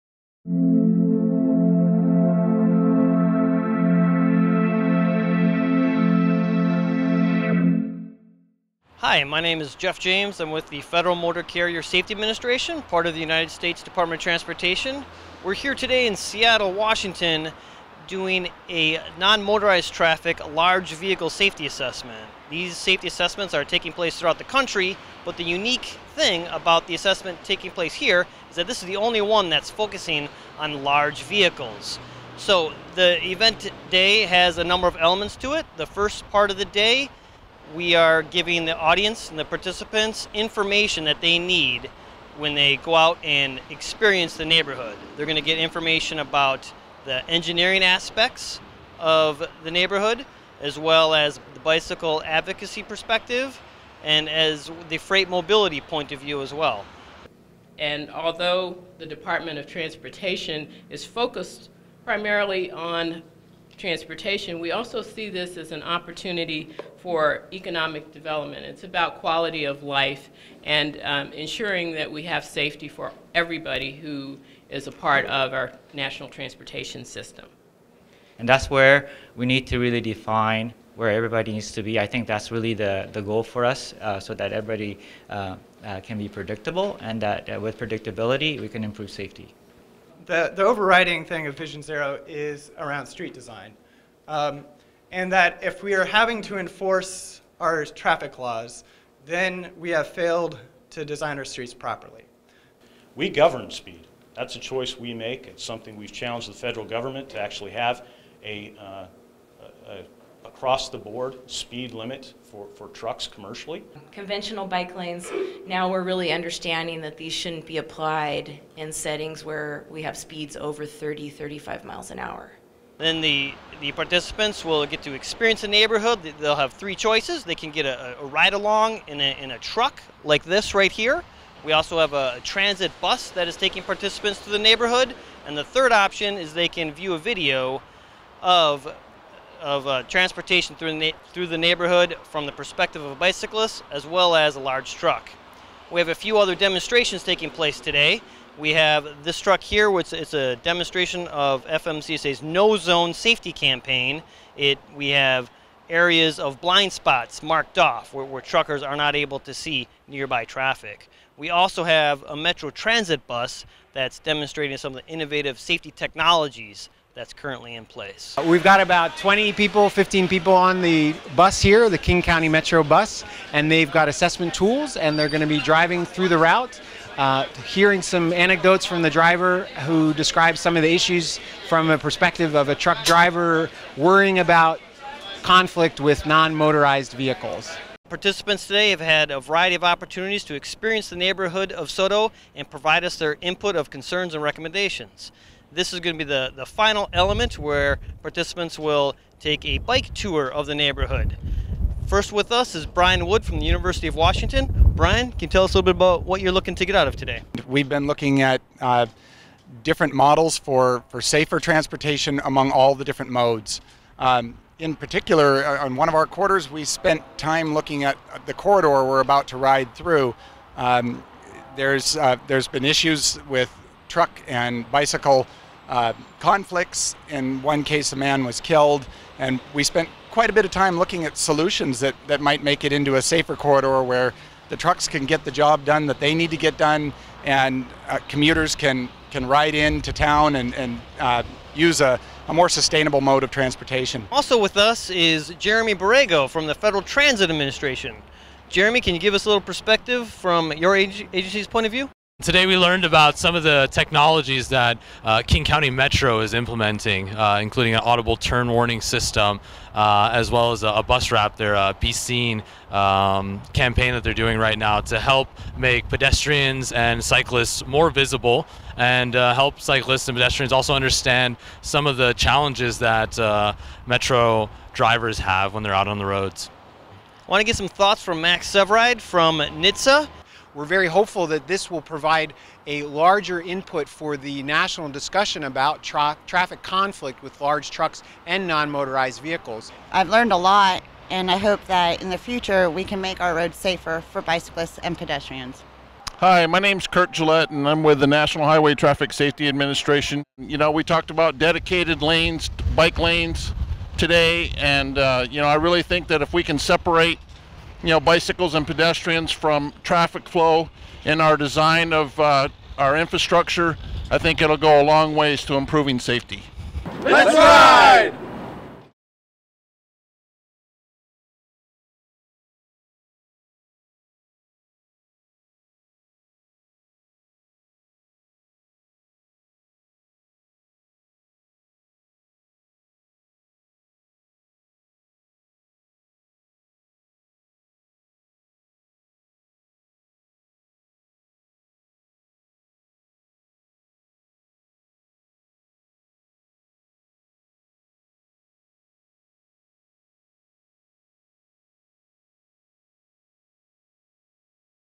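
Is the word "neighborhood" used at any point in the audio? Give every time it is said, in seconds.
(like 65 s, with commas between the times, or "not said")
44 s, 49 s, 125 s, 134 s, 141 s, 191 s, 200 s.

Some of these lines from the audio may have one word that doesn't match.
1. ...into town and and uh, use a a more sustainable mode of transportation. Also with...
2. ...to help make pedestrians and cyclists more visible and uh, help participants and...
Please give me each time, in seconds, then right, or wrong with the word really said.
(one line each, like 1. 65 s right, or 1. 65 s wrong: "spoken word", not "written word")
1. 239 s right
2. 265 s wrong: "cyclists", not "participants".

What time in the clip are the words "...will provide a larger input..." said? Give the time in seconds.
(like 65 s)
281 s.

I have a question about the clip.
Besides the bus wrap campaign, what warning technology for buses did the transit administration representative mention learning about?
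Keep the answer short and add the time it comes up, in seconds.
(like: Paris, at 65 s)
Audible turn warning system, at 258 s.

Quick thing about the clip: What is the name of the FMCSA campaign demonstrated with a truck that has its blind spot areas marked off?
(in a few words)
No Zone Safety Campaign.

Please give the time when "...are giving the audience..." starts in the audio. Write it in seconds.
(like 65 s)
37 s.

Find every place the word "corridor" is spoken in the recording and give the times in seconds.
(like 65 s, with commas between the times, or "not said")
218 s, 233 s.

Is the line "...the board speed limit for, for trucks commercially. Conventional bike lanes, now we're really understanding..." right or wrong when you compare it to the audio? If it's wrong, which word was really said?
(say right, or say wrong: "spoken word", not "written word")
right.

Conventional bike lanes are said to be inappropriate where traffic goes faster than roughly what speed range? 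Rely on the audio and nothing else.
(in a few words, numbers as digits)
30, 35 miles an hour.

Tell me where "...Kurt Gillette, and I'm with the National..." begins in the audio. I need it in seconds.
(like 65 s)
297 s.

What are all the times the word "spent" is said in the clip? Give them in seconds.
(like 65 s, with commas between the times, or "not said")
216 s, 229 s.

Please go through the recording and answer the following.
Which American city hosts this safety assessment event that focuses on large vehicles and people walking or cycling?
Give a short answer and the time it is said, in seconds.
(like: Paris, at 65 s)
Seattle, Washington, at 16 s.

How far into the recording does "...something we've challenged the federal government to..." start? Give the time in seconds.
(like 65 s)
105 s.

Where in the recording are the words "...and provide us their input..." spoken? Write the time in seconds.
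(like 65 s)
192 s.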